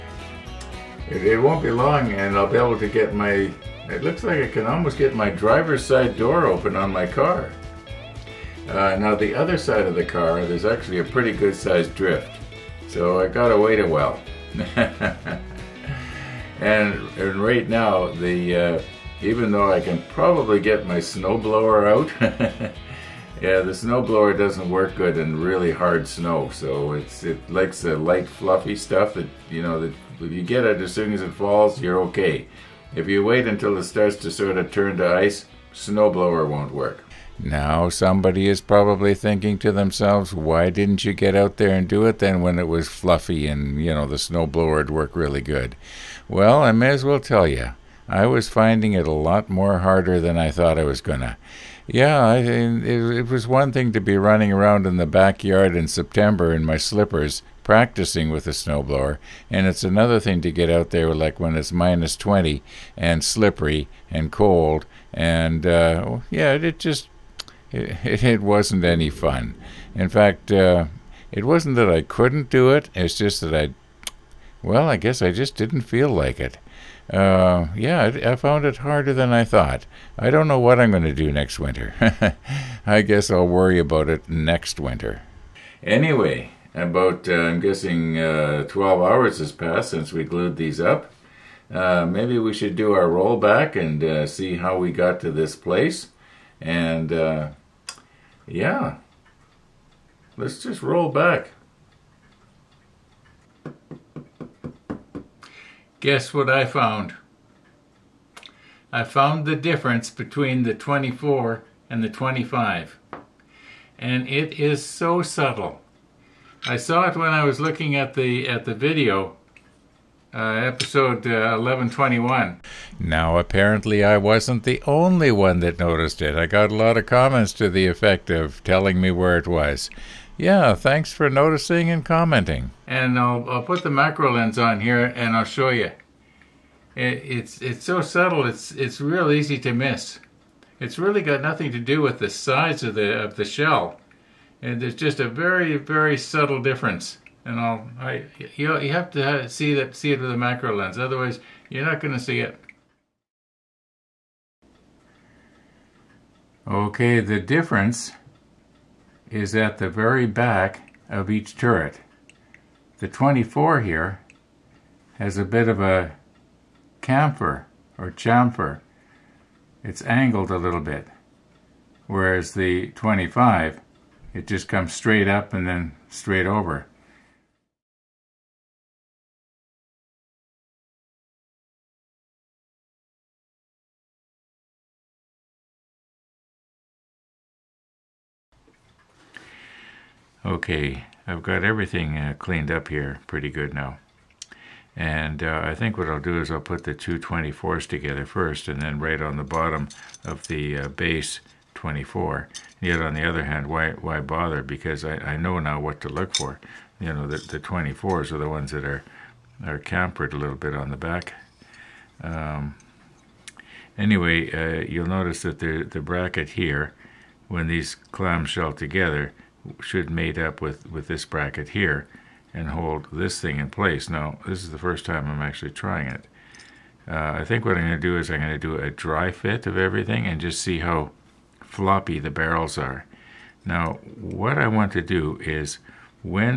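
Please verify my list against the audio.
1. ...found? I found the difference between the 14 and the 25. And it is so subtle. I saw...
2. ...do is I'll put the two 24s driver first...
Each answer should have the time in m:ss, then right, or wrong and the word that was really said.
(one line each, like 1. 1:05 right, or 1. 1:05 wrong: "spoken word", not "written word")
1. 1:46 wrong: "24", not "14"
2. 3:16 wrong: "together", not "driver".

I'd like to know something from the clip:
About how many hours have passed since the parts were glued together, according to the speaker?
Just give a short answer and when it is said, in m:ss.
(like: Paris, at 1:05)
12, at 1:28.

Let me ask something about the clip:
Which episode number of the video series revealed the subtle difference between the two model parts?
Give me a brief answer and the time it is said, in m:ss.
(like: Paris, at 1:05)
1121, at 2:01.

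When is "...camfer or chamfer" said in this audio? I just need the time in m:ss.
2:47.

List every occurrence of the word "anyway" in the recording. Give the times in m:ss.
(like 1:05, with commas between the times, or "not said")
1:25, 3:33.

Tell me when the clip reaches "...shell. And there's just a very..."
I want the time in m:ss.
2:23.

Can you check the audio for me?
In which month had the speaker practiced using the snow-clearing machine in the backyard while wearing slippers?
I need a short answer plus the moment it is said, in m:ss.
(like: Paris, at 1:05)
September, at 0:55.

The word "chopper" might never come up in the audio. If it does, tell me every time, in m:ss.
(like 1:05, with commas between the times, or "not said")
not said.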